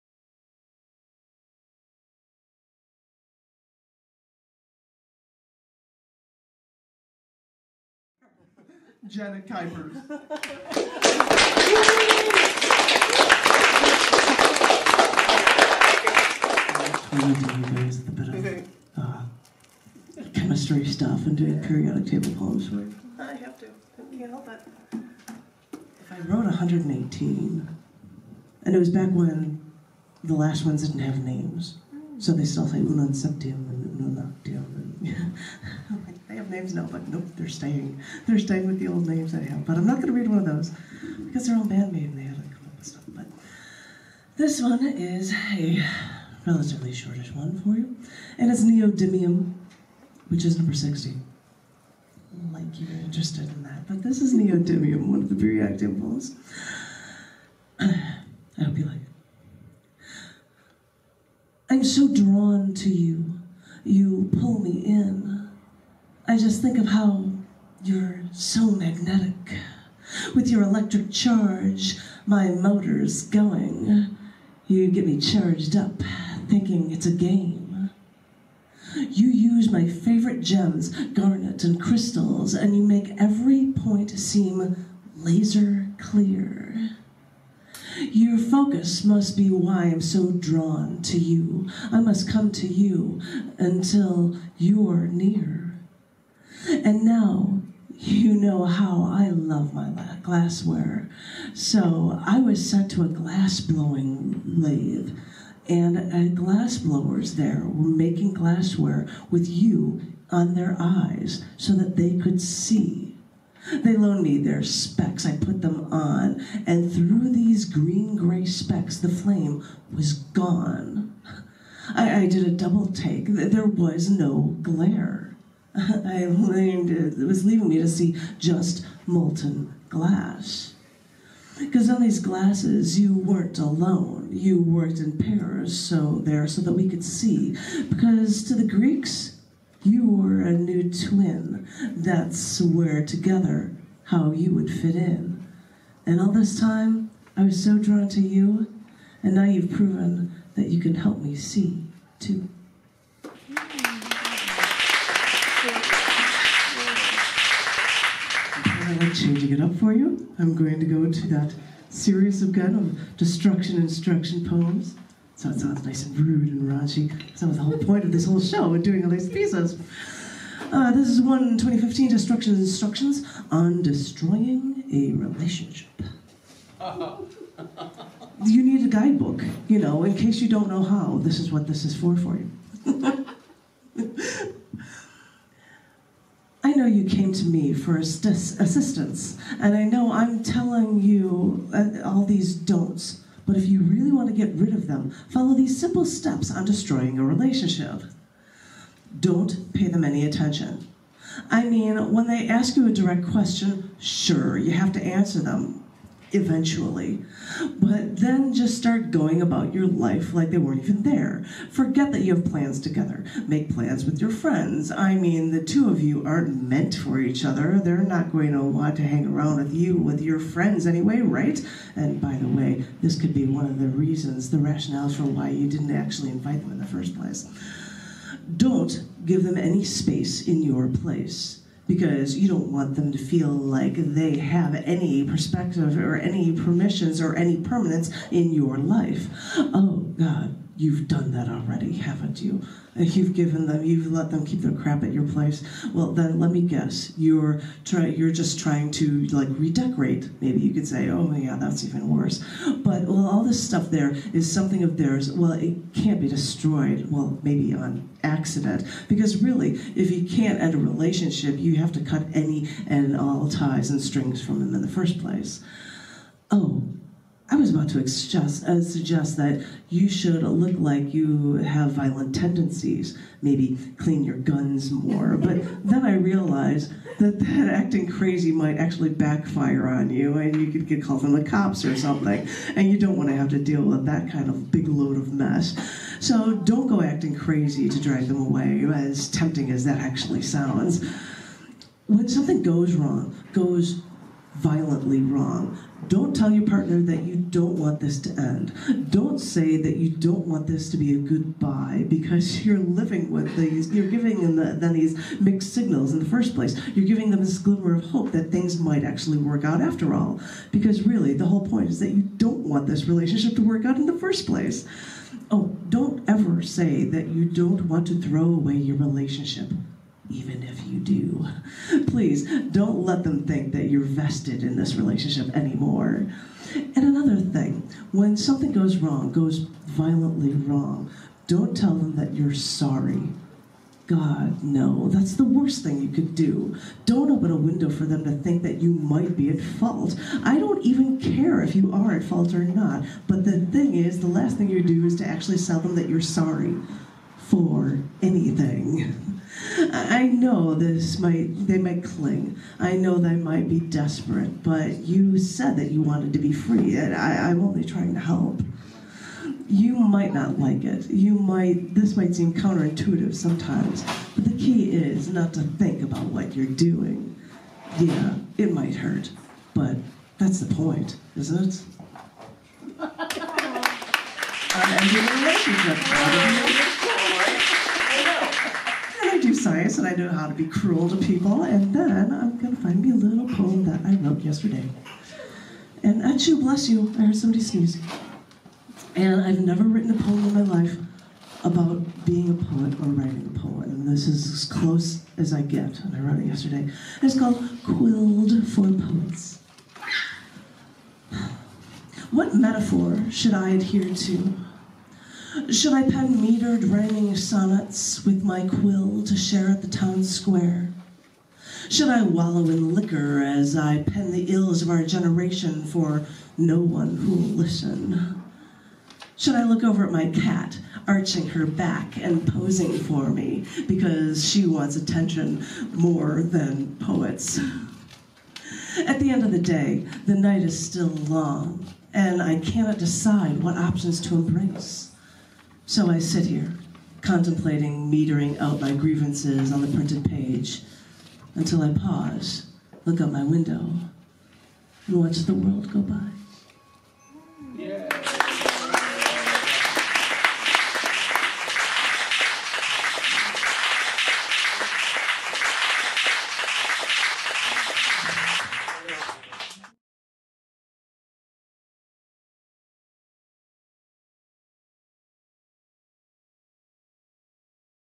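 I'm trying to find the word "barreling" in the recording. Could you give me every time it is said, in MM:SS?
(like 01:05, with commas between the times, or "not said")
not said.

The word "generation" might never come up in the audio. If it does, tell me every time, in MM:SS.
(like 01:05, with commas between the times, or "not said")
06:55.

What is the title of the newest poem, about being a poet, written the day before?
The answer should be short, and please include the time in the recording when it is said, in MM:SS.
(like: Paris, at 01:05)
Quilled for Poets, at 06:37.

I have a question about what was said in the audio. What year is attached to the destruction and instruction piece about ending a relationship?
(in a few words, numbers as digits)
2015.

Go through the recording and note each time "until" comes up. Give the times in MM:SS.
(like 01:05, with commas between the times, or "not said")
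01:33, 07:21.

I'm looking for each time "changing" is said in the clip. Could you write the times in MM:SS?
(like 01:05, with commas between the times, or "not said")
02:39.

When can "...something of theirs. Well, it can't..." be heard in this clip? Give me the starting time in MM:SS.
04:14.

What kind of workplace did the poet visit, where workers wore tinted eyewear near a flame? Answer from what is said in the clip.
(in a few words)
glass blowing lathe.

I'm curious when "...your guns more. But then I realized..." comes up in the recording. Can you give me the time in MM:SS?
04:34.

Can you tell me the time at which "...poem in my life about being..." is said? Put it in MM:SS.
06:30.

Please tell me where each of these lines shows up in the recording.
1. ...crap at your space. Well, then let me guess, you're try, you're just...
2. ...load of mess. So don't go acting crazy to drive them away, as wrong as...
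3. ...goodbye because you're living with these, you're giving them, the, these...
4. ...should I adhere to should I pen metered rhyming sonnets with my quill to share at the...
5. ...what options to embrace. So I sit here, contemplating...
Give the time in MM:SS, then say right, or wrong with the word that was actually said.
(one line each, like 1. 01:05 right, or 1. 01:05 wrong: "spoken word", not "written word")
1. 04:04 wrong: "place", not "space"
2. 04:44 wrong: "tempting", not "wrong"
3. 05:01 right
4. 06:43 right
5. 07:13 right.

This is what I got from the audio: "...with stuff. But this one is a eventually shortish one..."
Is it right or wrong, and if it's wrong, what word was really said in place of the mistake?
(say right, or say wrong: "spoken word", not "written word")
wrong: "relatively", not "eventually".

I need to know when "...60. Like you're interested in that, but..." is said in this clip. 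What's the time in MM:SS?
00:50.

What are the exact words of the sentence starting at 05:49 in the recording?
I know this might they might cling.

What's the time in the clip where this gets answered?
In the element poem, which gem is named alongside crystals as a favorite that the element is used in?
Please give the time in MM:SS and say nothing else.
01:21.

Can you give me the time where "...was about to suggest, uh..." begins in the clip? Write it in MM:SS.
04:27.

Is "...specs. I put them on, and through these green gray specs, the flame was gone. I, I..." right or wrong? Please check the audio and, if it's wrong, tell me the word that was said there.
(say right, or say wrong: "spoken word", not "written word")
right.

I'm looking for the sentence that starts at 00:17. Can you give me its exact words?
guys, the bit of chemistry stuff and doing periodic table poems for you.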